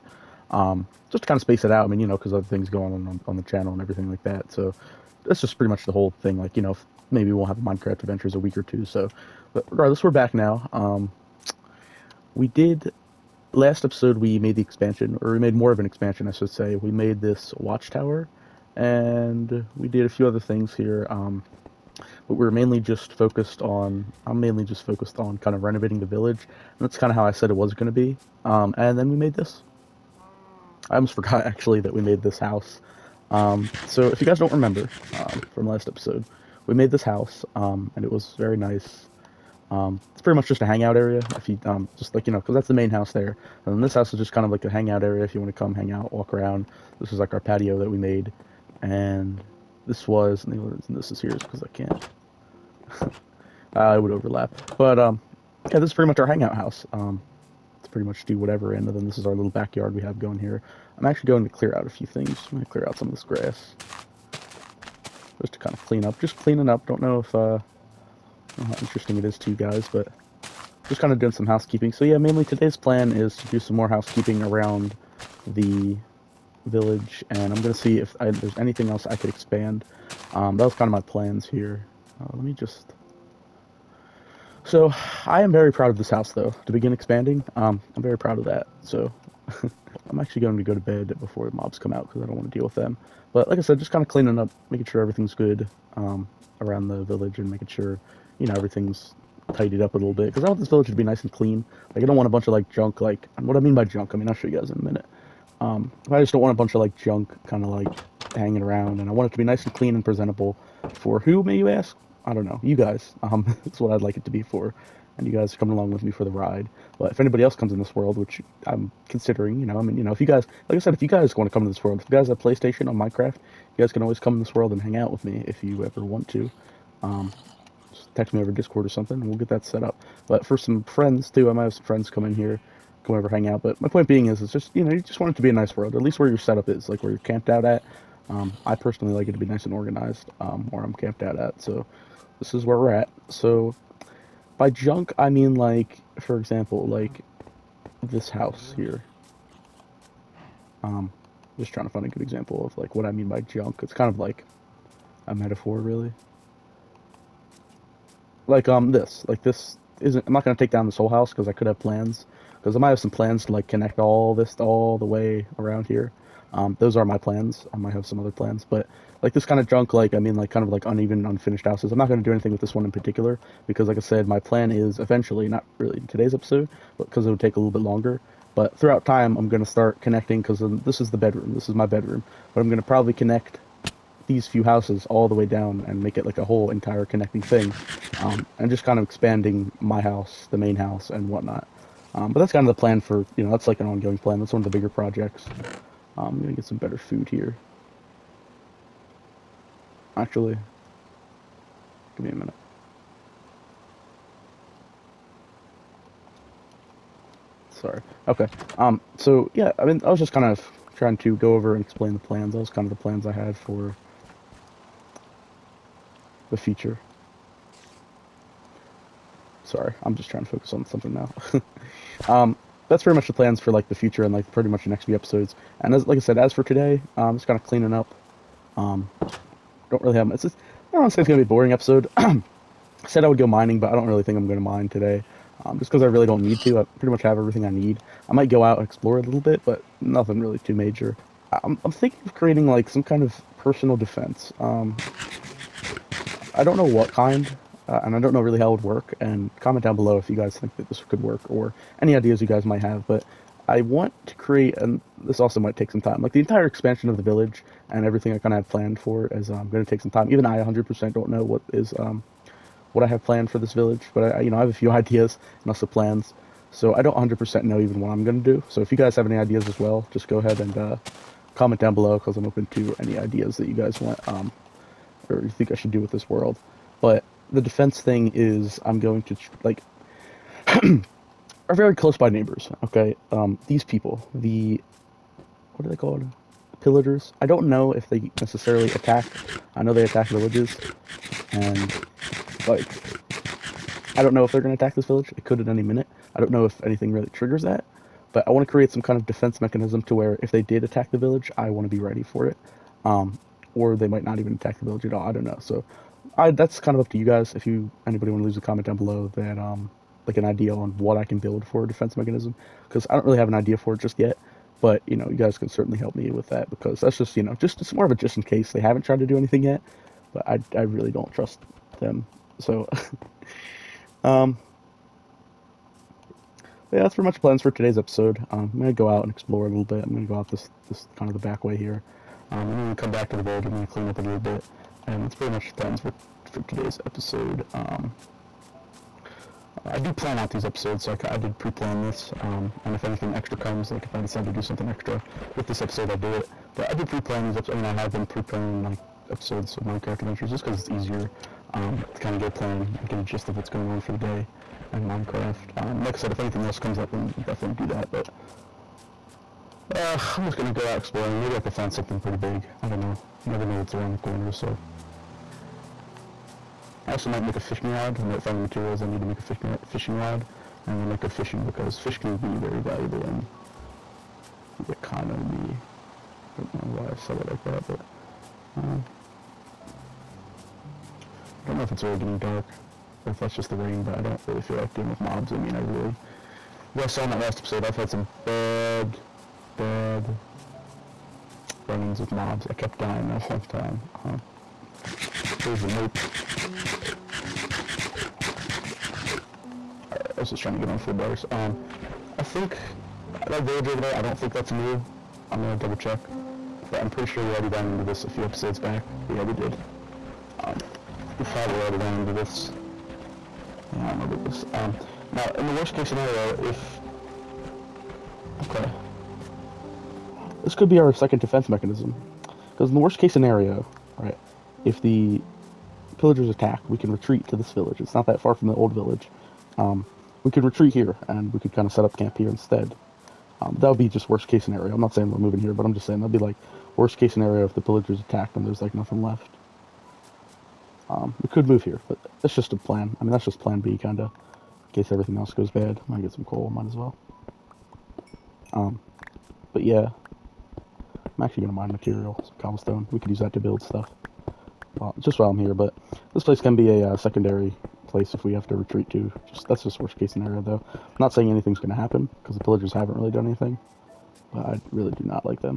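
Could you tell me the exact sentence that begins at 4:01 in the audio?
I'm I'm thinking of creating like some kind of personal defense.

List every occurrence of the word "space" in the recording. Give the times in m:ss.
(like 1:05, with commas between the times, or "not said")
0:01.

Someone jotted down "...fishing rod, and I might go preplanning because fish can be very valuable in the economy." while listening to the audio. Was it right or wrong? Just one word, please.
wrong.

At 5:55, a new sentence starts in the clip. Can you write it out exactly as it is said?
Um, like I said, if anything else comes up, then we'll definitely do that.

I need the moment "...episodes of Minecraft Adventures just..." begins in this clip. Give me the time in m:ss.
5:49.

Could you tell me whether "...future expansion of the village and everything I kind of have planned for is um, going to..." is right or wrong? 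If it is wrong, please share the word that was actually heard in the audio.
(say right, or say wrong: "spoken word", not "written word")
wrong: "entire", not "future".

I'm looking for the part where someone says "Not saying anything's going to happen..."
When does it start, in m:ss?
7:41.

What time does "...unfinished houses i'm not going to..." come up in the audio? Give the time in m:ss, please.
2:51.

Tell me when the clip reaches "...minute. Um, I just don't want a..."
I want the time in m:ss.
1:44.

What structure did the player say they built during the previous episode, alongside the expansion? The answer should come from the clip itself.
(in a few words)
watchtower.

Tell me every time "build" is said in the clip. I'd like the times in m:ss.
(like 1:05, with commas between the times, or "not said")
5:11, 7:33.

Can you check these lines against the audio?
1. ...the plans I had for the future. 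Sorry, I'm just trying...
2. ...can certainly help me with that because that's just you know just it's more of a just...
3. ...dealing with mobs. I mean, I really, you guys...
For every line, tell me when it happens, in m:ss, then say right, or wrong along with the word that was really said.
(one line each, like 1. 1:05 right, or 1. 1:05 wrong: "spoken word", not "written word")
1. 3:32 right
2. 5:15 right
3. 6:24 right.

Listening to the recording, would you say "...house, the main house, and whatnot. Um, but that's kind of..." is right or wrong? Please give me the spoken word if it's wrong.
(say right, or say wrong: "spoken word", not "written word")
right.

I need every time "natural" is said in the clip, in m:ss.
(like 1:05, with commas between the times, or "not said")
not said.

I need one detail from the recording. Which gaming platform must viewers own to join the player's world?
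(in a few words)
PlayStation.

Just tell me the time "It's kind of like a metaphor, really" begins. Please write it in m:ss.
2:33.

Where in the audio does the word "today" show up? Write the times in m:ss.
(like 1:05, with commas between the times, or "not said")
1:12, 2:56, 3:46, 3:54, 5:27, 5:36.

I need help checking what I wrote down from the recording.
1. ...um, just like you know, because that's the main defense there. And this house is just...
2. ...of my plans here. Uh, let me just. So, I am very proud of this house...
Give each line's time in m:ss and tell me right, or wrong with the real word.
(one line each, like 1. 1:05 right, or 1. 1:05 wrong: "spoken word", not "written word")
1. 0:41 wrong: "house", not "defense"
2. 1:20 right.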